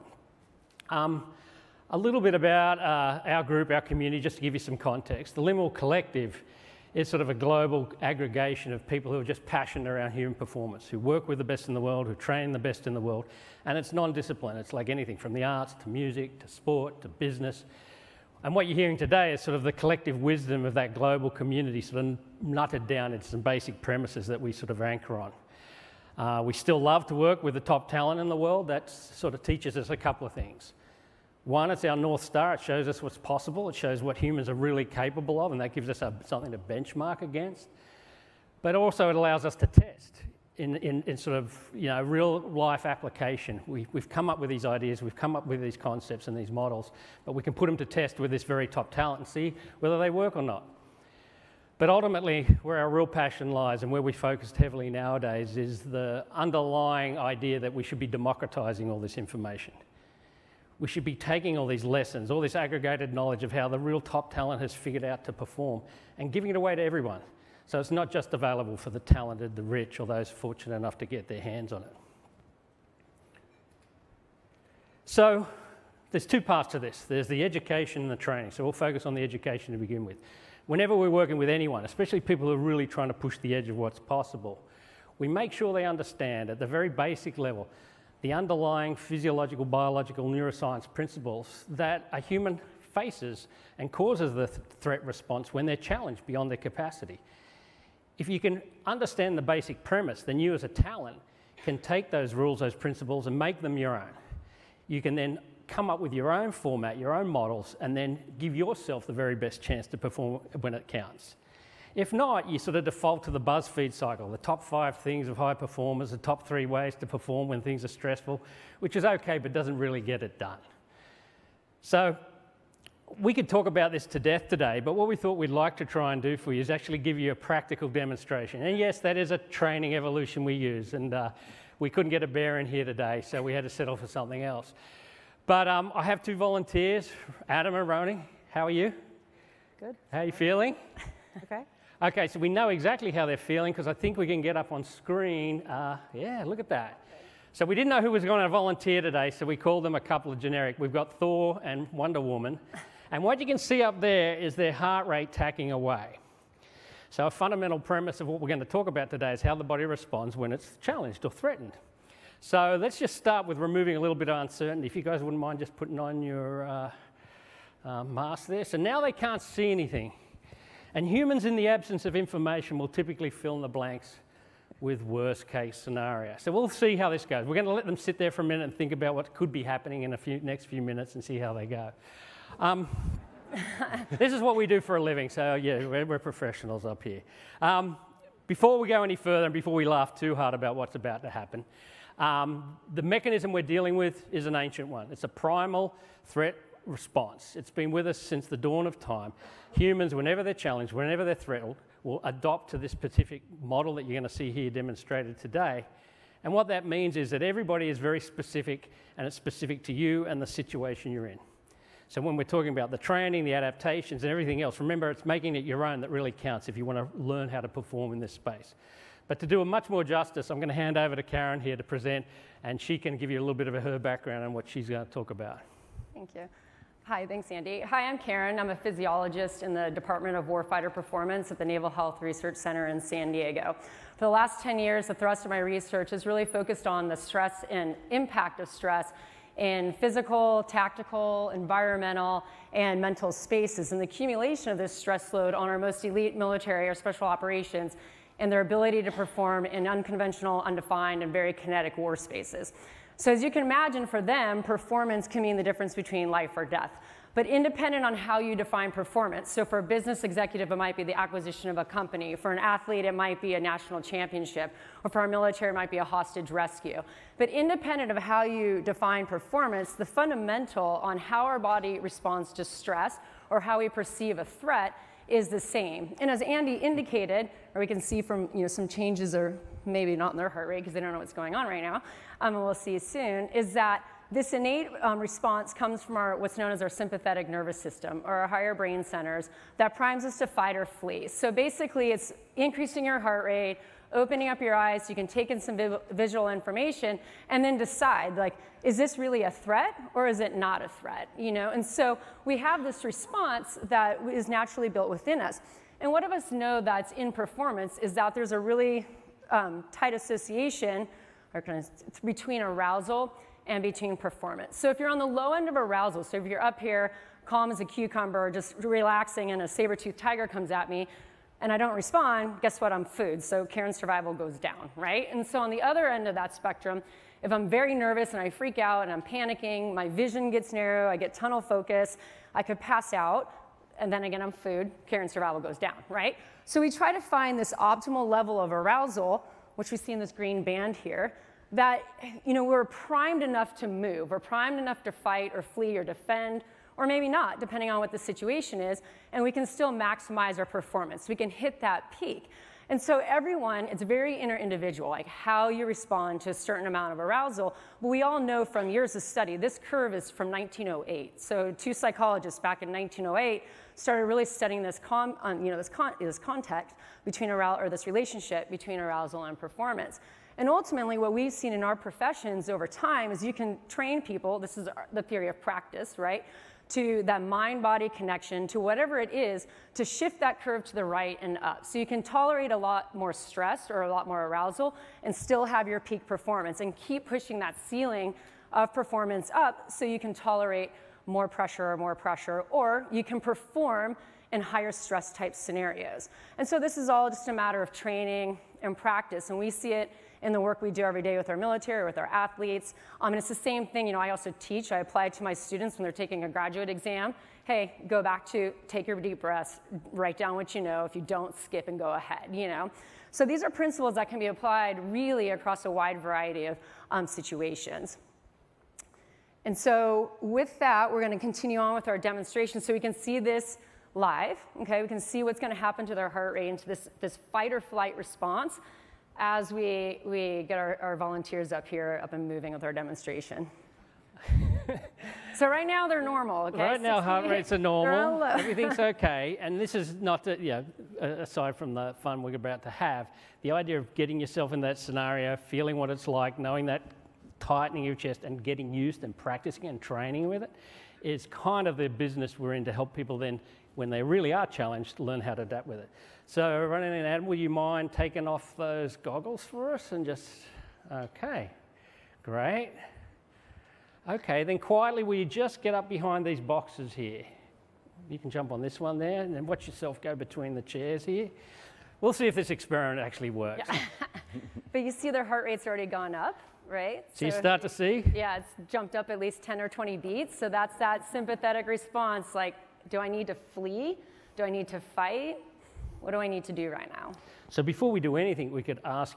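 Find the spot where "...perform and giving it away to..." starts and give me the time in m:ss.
1:05.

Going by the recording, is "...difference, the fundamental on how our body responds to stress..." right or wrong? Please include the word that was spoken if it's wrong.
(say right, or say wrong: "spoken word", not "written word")
wrong: "performance", not "difference".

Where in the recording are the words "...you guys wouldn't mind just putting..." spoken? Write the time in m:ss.
2:44.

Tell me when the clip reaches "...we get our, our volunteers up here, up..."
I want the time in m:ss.
7:10.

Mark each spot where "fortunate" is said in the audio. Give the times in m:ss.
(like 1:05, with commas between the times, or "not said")
1:10.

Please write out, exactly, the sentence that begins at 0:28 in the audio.
That sort of teaches us a couple of things.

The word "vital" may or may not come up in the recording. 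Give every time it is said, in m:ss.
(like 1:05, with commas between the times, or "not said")
not said.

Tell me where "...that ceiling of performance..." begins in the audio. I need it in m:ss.
6:27.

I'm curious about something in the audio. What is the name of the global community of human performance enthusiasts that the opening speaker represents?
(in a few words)
Limmel Collective.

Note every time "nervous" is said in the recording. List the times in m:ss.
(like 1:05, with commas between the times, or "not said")
4:47, 5:27.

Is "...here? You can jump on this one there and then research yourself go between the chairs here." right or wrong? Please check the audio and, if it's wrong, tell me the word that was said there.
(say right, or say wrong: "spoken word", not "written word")
wrong: "watch", not "research".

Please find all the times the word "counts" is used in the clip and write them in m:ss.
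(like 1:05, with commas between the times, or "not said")
1:50, 3:36.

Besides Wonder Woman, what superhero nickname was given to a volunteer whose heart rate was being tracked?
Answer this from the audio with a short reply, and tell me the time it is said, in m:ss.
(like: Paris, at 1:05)
Thor, at 2:31.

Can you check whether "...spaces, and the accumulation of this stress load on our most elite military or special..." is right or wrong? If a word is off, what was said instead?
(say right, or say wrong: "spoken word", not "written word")
right.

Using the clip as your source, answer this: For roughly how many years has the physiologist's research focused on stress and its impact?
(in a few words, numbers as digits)
10.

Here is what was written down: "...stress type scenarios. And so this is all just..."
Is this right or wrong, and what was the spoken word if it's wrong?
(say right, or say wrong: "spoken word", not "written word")
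right.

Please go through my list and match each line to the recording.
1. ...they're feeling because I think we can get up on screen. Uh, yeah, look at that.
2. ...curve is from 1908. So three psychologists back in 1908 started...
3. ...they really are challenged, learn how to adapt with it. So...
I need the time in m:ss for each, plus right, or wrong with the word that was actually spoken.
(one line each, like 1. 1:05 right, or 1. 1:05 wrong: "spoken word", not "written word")
1. 2:23 right
2. 5:59 wrong: "two", not "three"
3. 7:34 right.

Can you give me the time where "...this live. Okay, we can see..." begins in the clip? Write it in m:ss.
7:03.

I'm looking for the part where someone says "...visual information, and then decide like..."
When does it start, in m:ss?
4:56.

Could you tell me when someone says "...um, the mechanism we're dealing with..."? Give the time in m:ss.
3:12.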